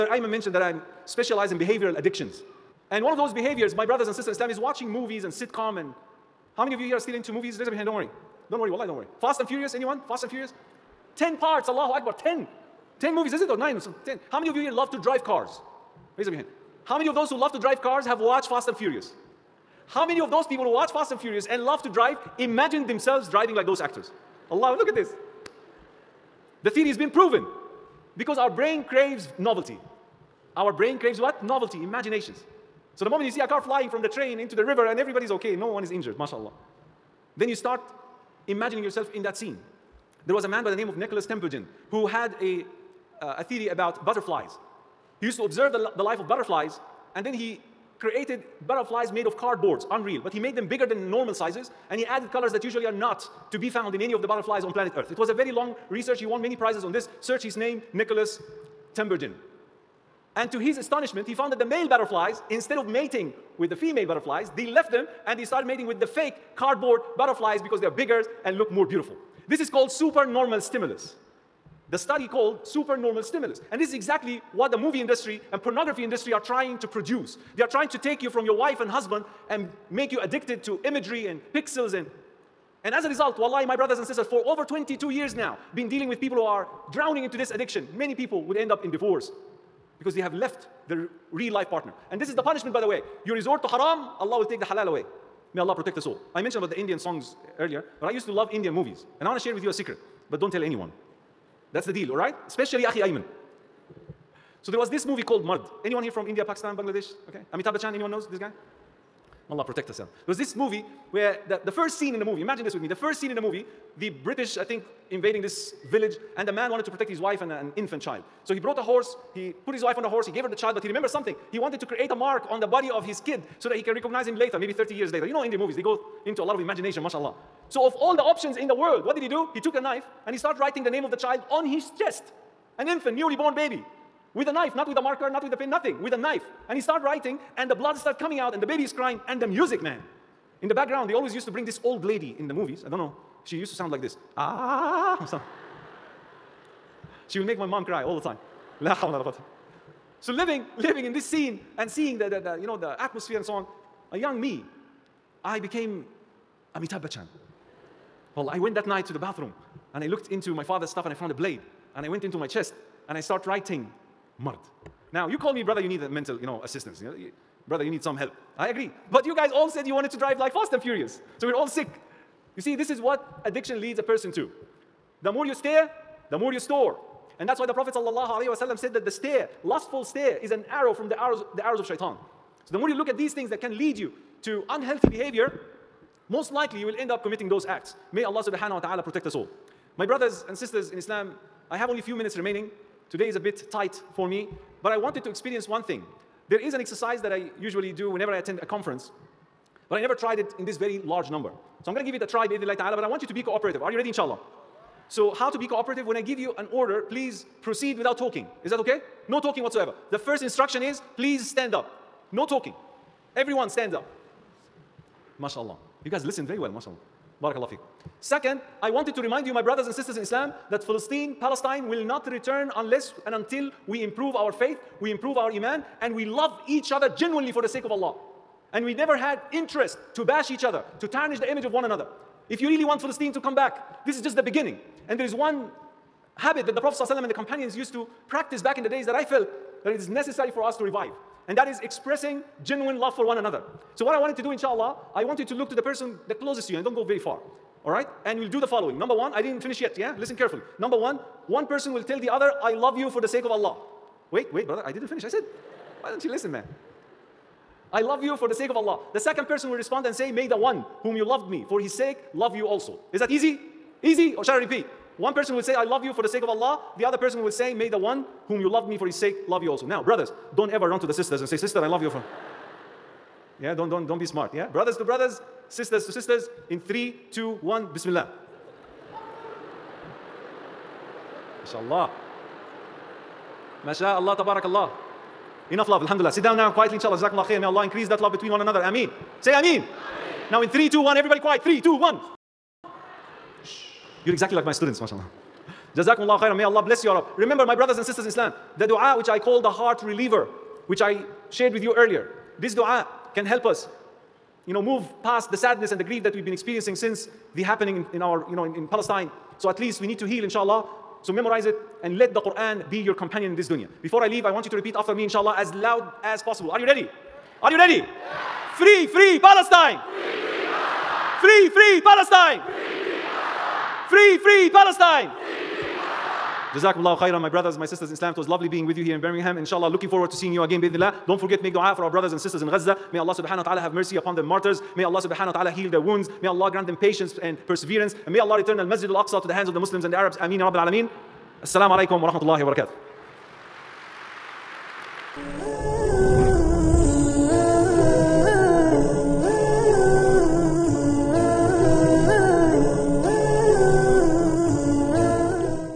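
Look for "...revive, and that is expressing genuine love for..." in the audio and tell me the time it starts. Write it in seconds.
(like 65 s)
240 s.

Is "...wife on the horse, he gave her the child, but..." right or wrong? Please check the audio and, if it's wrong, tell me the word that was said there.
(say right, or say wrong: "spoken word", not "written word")
right.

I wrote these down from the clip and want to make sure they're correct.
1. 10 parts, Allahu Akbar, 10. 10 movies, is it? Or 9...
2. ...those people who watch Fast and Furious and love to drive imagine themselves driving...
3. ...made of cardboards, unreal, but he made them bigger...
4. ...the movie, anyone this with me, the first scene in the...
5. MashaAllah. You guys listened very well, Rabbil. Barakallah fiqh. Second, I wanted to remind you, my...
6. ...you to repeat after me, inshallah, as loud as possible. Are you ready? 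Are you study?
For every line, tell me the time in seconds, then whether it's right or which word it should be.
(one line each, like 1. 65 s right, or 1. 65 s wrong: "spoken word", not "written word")
1. 11 s right
2. 20 s right
3. 49 s right
4. 112 s wrong: "imagine", not "anyone"
5. 215 s wrong: "MashaAllah", not "Rabbil"
6. 314 s wrong: "ready", not "study".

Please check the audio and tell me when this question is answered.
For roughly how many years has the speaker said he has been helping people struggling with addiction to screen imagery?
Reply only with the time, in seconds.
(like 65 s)
84 s.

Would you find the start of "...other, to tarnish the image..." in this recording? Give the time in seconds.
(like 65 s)
230 s.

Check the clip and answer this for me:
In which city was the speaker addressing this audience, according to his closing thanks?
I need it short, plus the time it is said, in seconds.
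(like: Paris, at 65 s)
Birmingham, at 329 s.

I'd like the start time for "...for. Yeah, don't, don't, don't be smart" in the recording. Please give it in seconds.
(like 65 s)
272 s.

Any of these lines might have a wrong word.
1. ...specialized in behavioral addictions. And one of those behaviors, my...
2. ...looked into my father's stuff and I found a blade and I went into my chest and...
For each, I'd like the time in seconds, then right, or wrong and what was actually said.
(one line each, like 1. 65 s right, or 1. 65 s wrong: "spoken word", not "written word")
1. 1 s right
2. 160 s right.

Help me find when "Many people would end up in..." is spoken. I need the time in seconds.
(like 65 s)
87 s.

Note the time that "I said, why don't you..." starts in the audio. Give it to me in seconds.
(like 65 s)
255 s.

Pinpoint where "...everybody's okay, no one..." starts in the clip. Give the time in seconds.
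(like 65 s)
34 s.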